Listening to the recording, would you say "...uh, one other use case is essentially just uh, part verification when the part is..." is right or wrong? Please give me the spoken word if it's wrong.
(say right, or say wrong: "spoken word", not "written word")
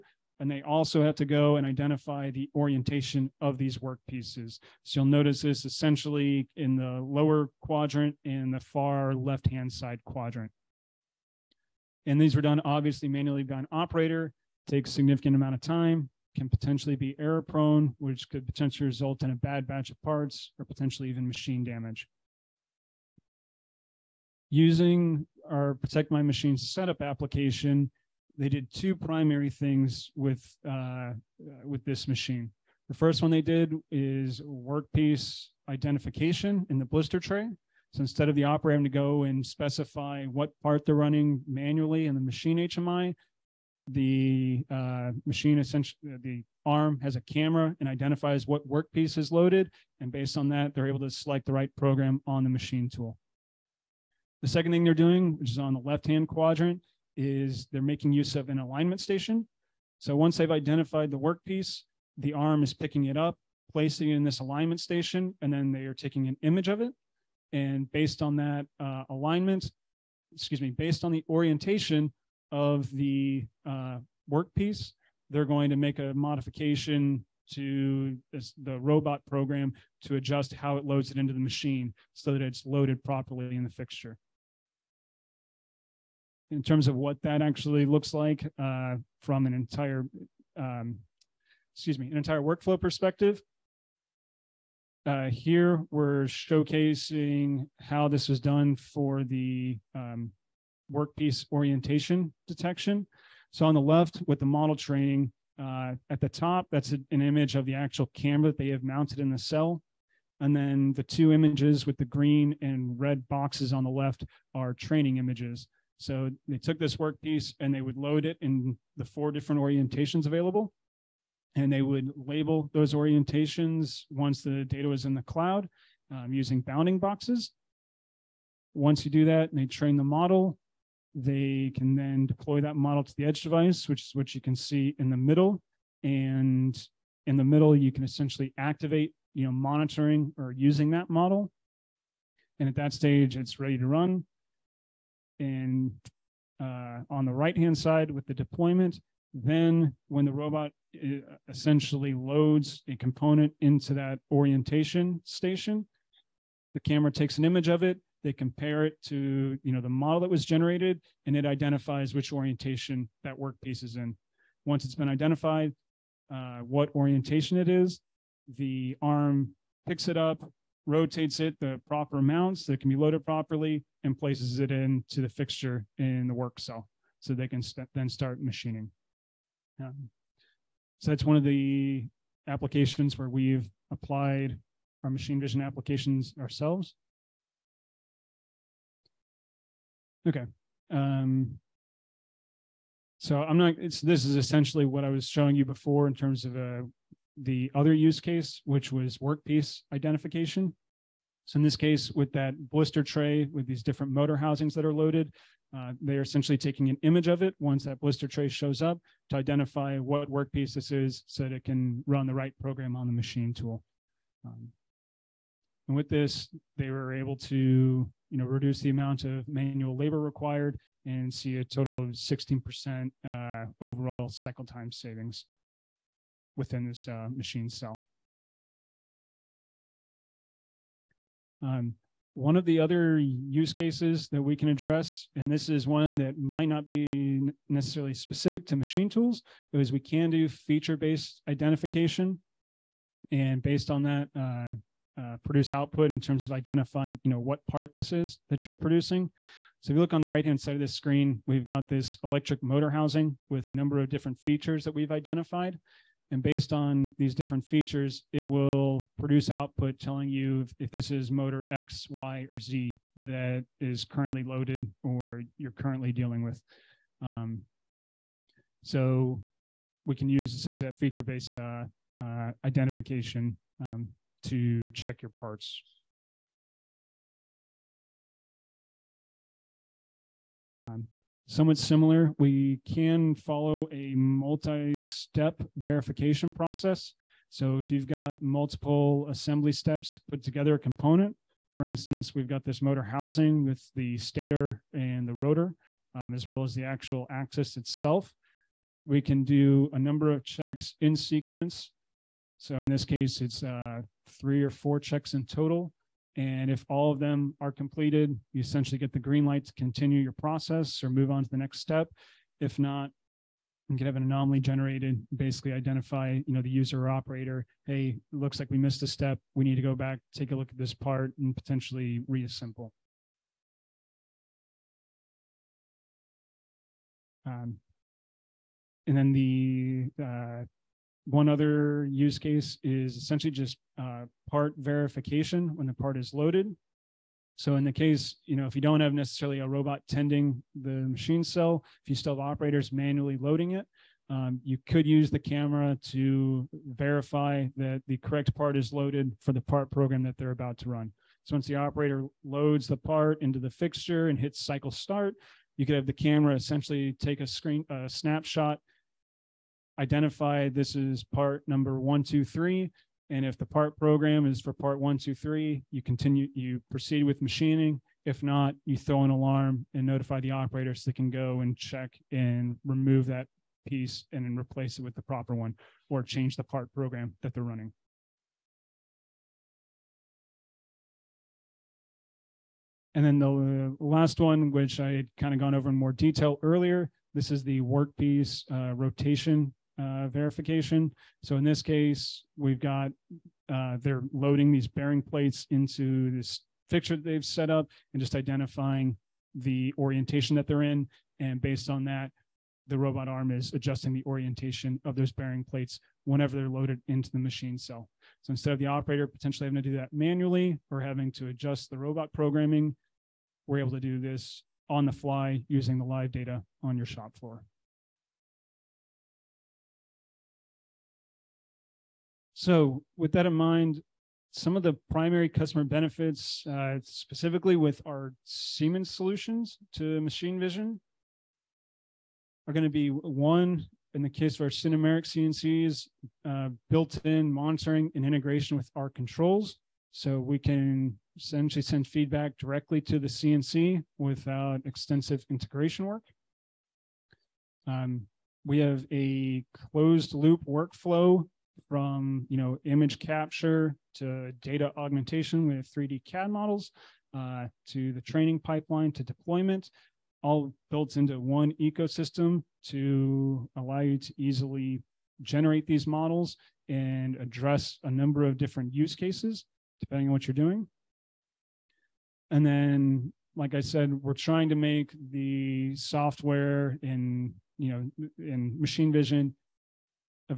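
right.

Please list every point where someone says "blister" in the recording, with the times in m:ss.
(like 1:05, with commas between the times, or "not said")
0:36, 3:22, 3:28.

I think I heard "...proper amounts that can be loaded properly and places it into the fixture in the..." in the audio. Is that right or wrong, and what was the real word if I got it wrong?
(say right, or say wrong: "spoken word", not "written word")
right.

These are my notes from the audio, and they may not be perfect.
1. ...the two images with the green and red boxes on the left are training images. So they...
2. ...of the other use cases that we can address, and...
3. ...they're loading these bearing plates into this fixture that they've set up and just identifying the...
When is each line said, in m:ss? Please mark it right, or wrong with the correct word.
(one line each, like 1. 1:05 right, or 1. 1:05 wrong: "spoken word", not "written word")
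1. 1:50 right
2. 3:52 right
3. 6:34 right.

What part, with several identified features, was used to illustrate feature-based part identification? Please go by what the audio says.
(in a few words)
Electric motor housing.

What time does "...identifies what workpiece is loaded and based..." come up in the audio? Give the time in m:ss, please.
0:47.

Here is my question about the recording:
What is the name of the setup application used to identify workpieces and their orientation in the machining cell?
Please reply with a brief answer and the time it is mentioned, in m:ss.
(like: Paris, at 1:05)
Protect My Machine, at 0:25.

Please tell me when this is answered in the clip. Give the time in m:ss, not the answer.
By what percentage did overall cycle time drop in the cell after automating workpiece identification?
3:42.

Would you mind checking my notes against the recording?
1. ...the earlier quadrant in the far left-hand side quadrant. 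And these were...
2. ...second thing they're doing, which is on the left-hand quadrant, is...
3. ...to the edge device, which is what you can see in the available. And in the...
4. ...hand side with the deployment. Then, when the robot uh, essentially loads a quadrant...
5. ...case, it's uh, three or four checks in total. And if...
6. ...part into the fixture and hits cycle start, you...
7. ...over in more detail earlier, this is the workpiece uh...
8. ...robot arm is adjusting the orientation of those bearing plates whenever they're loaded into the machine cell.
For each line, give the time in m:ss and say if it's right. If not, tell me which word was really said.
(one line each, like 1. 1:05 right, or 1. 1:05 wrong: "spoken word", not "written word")
1. 0:06 wrong: "lower", not "earlier"
2. 0:54 right
3. 2:13 wrong: "middle", not "available"
4. 2:27 wrong: "component", not "quadrant"
5. 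5:03 right
6. 5:52 right
7. 6:25 right
8. 6:42 right.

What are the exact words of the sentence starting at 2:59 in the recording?
Um, so that's one of the applications where we've applied our machine vision applications ourselves.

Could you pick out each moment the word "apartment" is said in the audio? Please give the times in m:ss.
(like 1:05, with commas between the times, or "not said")
not said.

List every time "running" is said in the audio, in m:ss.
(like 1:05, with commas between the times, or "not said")
0:40, 6:17.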